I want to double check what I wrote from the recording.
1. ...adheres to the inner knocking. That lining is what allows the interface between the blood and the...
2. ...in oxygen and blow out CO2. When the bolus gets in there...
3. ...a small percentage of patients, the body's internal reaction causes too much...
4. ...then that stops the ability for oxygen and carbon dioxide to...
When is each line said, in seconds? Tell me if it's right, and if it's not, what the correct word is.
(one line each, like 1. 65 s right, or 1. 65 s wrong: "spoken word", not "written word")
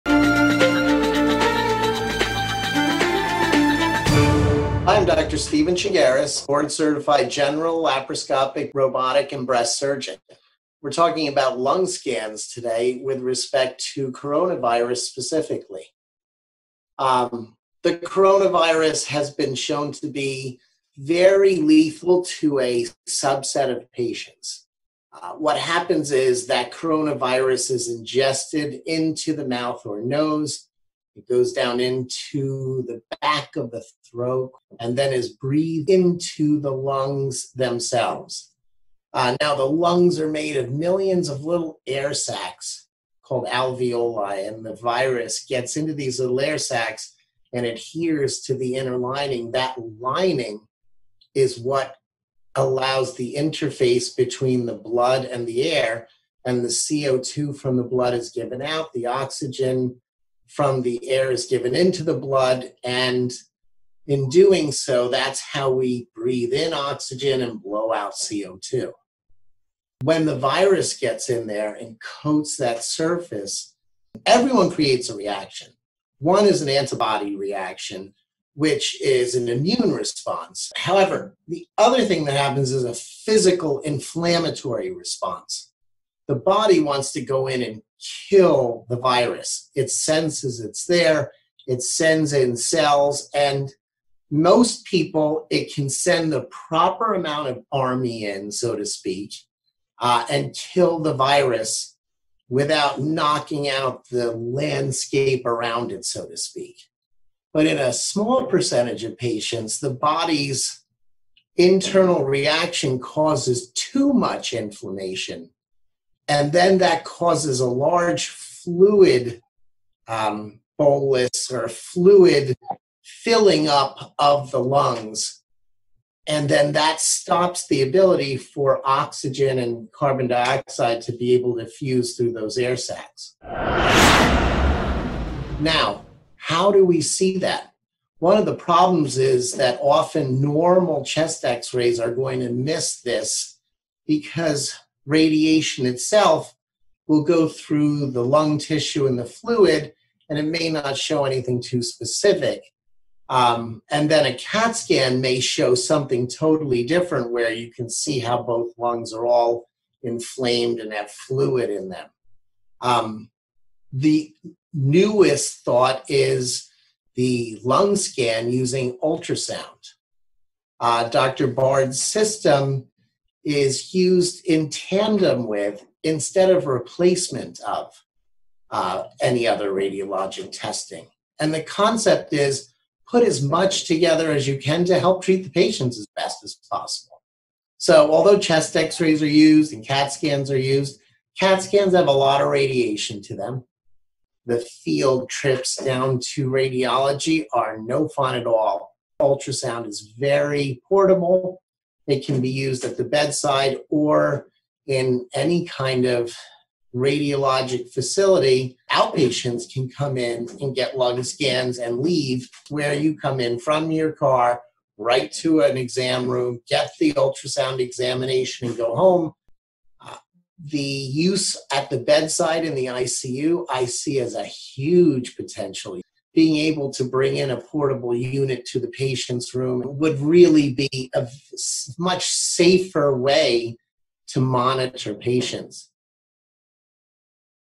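1. 47 s wrong: "lining", not "knocking"
2. 66 s wrong: "virus", not "bolus"
3. 107 s right
4. 126 s right.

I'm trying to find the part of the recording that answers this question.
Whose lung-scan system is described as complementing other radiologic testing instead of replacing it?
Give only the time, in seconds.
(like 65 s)
171 s.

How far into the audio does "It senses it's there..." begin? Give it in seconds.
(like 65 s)
89 s.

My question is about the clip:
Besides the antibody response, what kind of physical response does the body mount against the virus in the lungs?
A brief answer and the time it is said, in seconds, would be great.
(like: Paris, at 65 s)
inflammatory response, at 83 s.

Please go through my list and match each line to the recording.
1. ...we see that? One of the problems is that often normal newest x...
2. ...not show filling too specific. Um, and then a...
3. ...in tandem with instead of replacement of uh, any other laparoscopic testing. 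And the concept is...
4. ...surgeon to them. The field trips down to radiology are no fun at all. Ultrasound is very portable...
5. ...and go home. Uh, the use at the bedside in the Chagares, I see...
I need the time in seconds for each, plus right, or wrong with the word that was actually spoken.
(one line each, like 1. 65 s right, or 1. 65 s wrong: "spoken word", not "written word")
1. 136 s wrong: "chest", not "newest"
2. 150 s wrong: "anything", not "filling"
3. 174 s wrong: "radiologic", not "laparoscopic"
4. 192 s wrong: "radiation", not "surgeon"
5. 218 s wrong: "ICU", not "Chagares".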